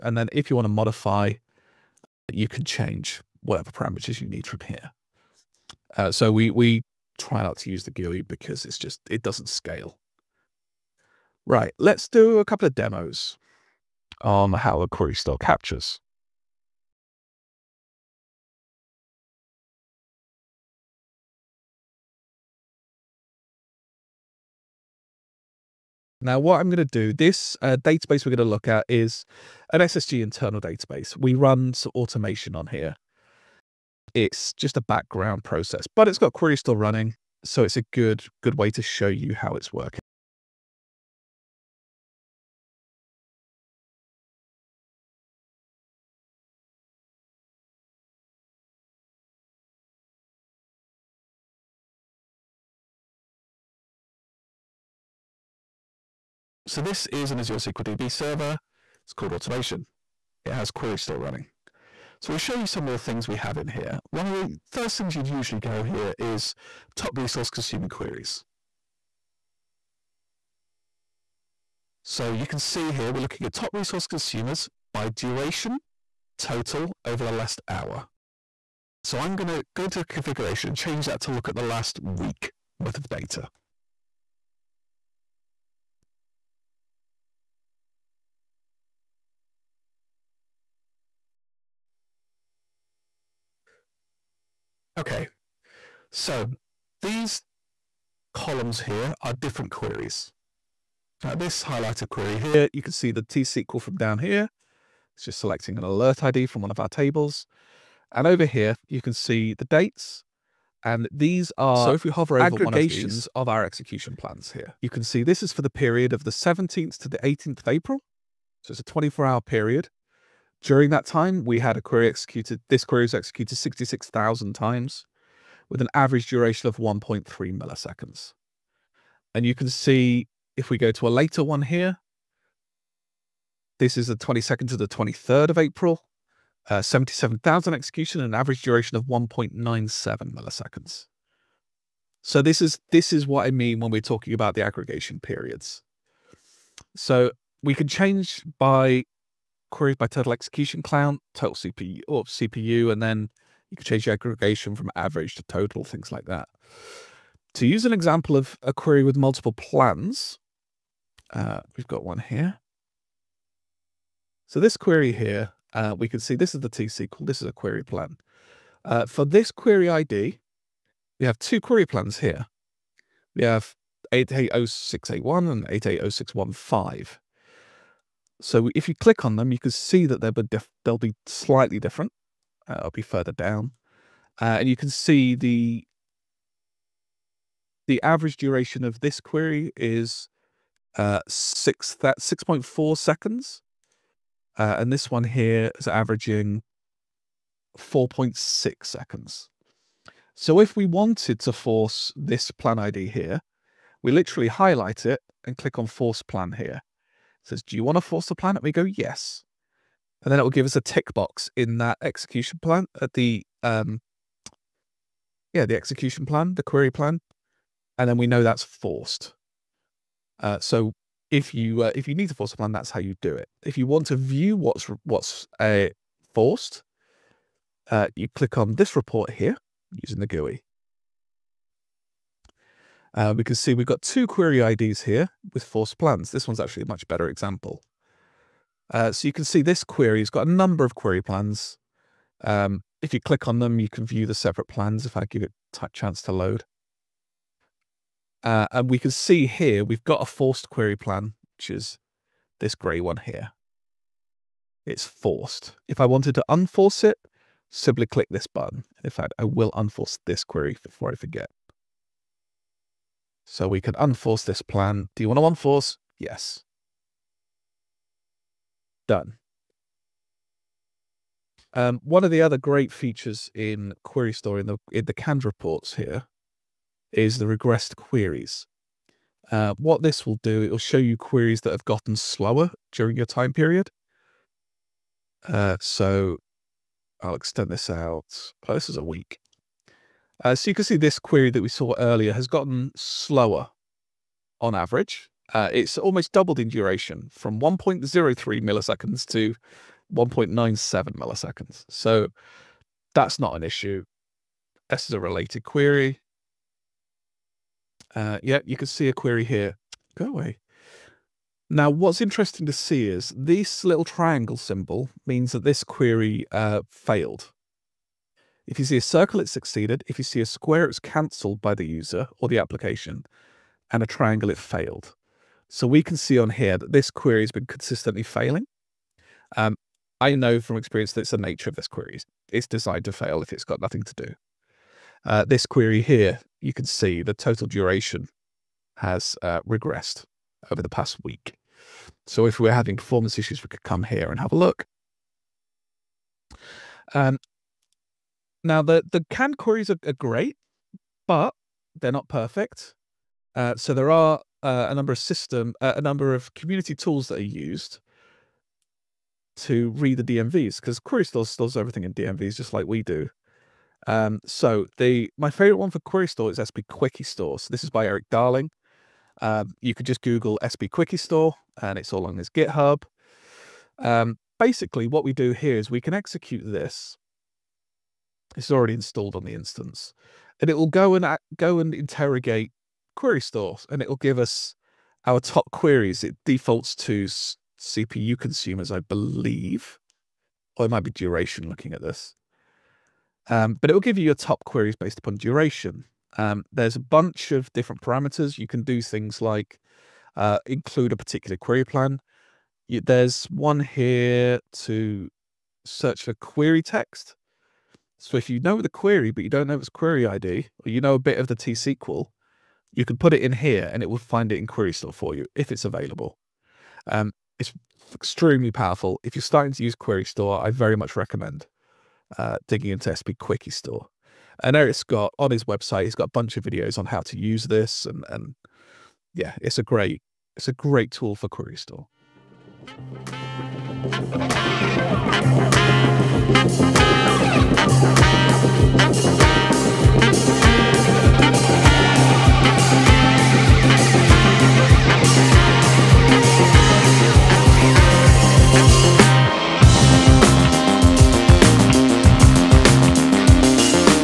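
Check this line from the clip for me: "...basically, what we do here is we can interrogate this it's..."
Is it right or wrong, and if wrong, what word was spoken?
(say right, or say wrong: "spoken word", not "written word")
wrong: "execute", not "interrogate".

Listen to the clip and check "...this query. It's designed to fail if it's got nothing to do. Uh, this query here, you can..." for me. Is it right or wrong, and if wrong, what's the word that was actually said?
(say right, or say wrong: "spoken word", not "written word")
right.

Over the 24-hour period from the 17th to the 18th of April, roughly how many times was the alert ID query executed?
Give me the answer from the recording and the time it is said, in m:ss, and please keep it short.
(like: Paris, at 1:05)
66,000, at 2:03.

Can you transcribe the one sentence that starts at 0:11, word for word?
Right, let's do a couple of demos on how a query store captures.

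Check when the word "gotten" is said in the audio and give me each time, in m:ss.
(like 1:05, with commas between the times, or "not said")
4:41, 4:52.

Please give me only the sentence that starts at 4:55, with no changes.
Uh, it's almost doubled in duration from 1.03 milliseconds to 1.97 milliseconds.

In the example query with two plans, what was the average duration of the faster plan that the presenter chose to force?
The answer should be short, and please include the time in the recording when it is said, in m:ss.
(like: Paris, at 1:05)
4.6 seconds, at 3:17.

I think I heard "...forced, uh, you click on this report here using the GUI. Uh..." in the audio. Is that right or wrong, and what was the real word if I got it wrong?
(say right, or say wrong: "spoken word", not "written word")
right.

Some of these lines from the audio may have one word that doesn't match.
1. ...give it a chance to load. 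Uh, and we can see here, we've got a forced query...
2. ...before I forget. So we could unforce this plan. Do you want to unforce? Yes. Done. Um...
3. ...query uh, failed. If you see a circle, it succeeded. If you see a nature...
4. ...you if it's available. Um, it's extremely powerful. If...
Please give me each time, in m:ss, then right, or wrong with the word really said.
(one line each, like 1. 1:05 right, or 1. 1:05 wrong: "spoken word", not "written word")
1. 4:05 right
2. 4:20 right
3. 5:15 wrong: "square", not "nature"
4. 6:55 right.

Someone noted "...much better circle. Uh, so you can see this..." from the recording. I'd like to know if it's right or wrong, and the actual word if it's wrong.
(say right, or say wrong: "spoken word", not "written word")
wrong: "example", not "circle".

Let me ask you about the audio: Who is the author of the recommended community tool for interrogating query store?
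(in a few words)
Erik Darling.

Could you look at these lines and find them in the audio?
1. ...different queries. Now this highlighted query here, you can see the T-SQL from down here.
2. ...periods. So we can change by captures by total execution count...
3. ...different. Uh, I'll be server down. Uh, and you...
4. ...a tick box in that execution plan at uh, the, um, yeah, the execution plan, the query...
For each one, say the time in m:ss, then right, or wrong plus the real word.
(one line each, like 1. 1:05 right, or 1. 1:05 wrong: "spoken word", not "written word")
1. 1:39 right
2. 2:25 wrong: "queries", not "captures"
3. 3:01 wrong: "further", not "server"
4. 3:30 right.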